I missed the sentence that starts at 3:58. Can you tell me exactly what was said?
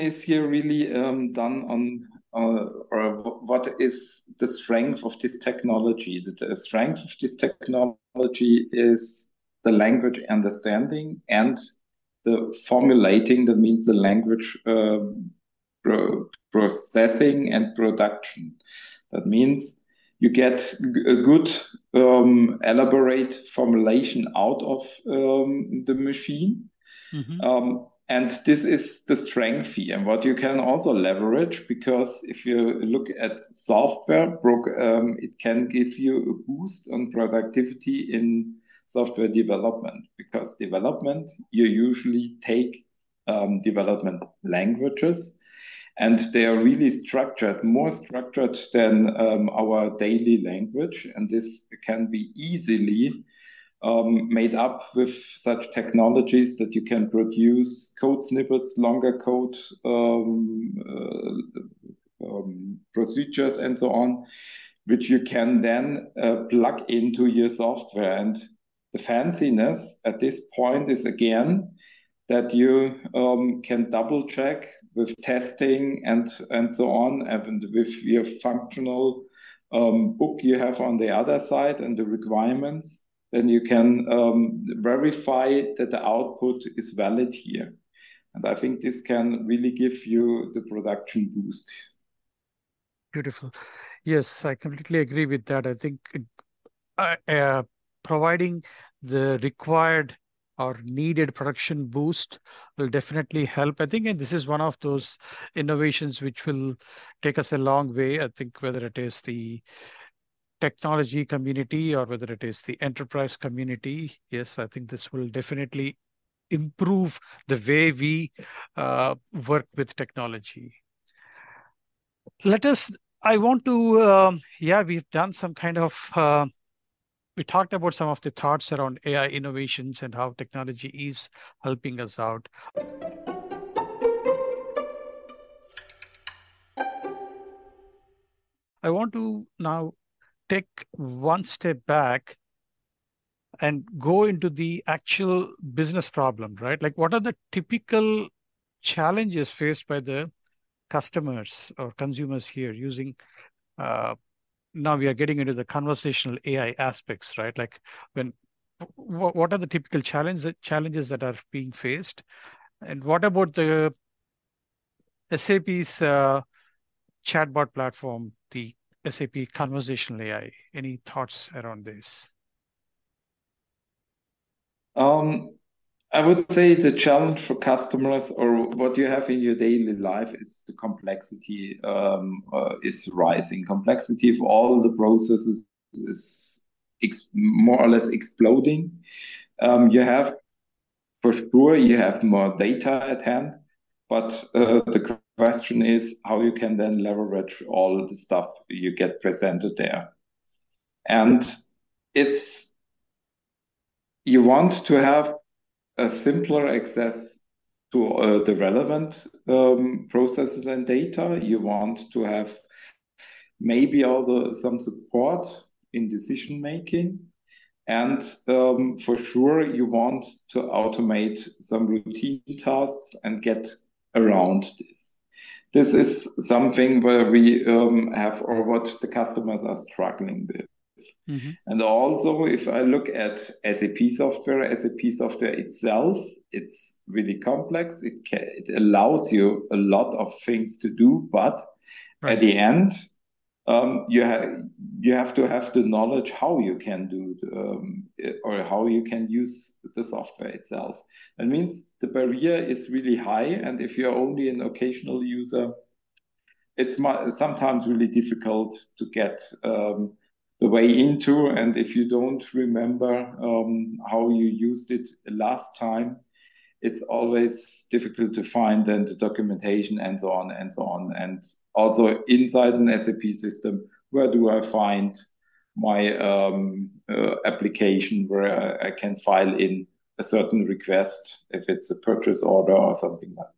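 It, can, it allows you a lot of things to do, but right.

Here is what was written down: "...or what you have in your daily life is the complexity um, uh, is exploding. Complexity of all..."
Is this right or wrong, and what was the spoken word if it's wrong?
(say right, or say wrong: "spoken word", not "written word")
wrong: "rising", not "exploding".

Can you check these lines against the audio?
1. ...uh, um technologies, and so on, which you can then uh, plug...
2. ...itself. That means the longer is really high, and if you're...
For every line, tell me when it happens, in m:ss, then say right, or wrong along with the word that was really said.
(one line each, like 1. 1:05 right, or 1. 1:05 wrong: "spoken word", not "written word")
1. 1:00 wrong: "procedures", not "technologies"
2. 4:10 wrong: "barrier", not "longer".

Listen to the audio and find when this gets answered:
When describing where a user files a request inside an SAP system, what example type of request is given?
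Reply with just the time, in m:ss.
4:41.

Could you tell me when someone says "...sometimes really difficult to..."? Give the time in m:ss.
4:17.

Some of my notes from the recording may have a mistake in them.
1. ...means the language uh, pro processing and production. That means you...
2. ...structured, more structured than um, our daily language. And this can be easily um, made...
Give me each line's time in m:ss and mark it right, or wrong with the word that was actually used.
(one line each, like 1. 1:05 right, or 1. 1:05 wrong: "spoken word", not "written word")
1. 0:13 right
2. 0:46 right.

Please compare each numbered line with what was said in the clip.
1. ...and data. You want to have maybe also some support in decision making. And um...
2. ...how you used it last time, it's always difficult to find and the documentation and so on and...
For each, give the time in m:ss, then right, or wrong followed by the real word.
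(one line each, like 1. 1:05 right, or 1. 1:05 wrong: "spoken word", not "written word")
1. 3:30 right
2. 4:24 right.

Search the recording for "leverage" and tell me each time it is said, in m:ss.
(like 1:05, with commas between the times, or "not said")
0:30, 3:17.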